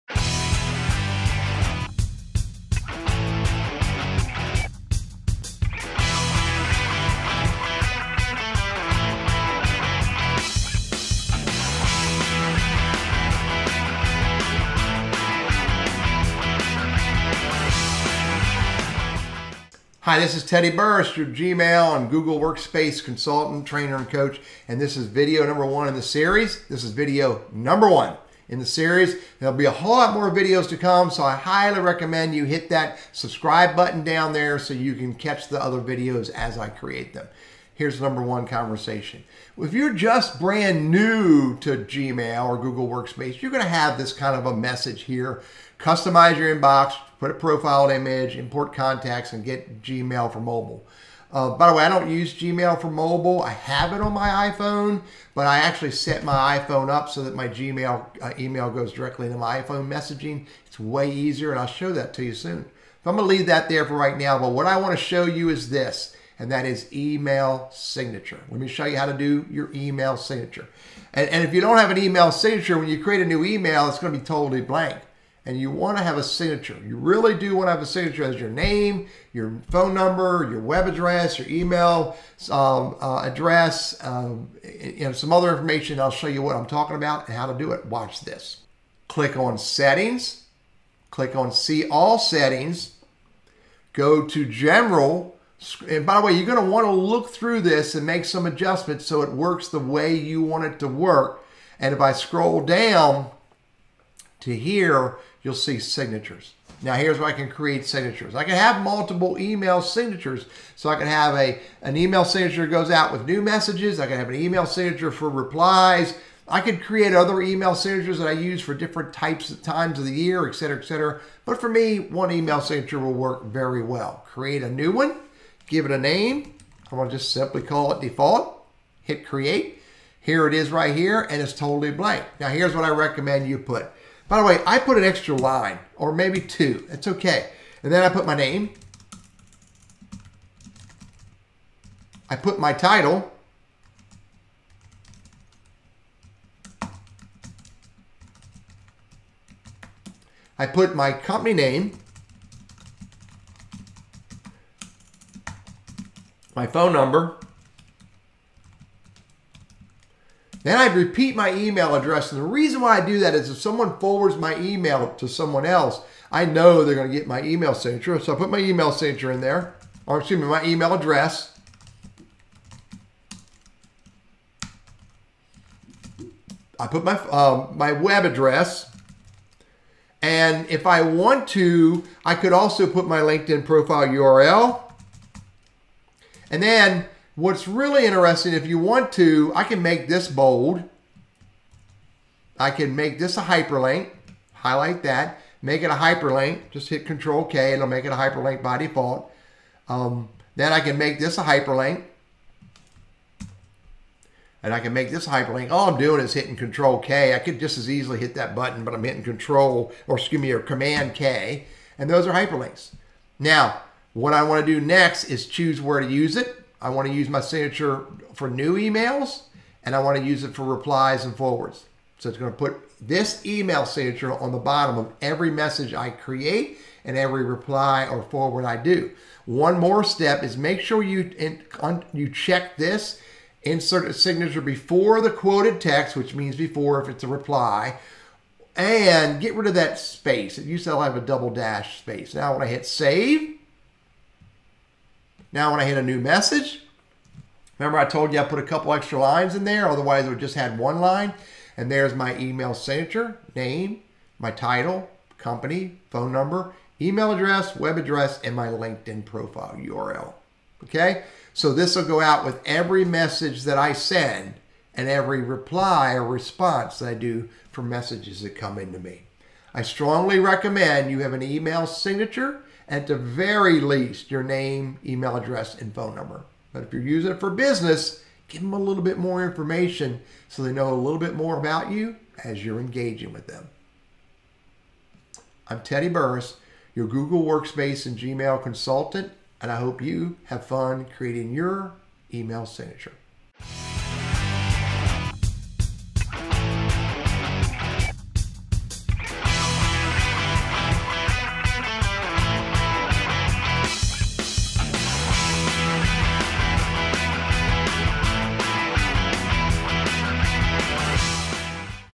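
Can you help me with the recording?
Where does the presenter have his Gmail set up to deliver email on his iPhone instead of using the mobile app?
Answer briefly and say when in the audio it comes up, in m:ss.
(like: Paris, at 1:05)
iPhone messaging, at 0:59.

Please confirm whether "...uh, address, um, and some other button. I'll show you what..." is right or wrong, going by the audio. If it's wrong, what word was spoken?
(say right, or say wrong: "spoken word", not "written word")
wrong: "information", not "button".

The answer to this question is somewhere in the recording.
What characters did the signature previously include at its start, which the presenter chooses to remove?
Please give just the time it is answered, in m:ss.
4:01.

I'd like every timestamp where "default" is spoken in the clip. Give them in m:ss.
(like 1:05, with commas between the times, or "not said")
2:08, 3:18.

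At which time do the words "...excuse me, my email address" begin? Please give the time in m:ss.
2:50.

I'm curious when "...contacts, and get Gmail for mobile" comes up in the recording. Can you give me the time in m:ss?
0:48.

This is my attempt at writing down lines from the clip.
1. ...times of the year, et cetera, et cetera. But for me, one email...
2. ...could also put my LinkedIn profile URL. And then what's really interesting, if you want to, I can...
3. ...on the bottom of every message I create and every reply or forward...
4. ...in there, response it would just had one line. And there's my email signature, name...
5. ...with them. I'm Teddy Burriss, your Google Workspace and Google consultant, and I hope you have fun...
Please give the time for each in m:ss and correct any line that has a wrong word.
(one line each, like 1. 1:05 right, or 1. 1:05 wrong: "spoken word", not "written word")
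1. 1:59 right
2. 3:02 right
3. 3:44 right
4. 4:09 wrong: "otherwise", not "response"
5. 4:43 wrong: "Gmail", not "Google".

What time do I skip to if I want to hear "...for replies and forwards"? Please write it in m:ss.
3:40.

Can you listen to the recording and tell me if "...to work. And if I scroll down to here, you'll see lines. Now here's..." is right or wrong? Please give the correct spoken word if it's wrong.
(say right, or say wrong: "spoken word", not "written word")
wrong: "signatures", not "lines".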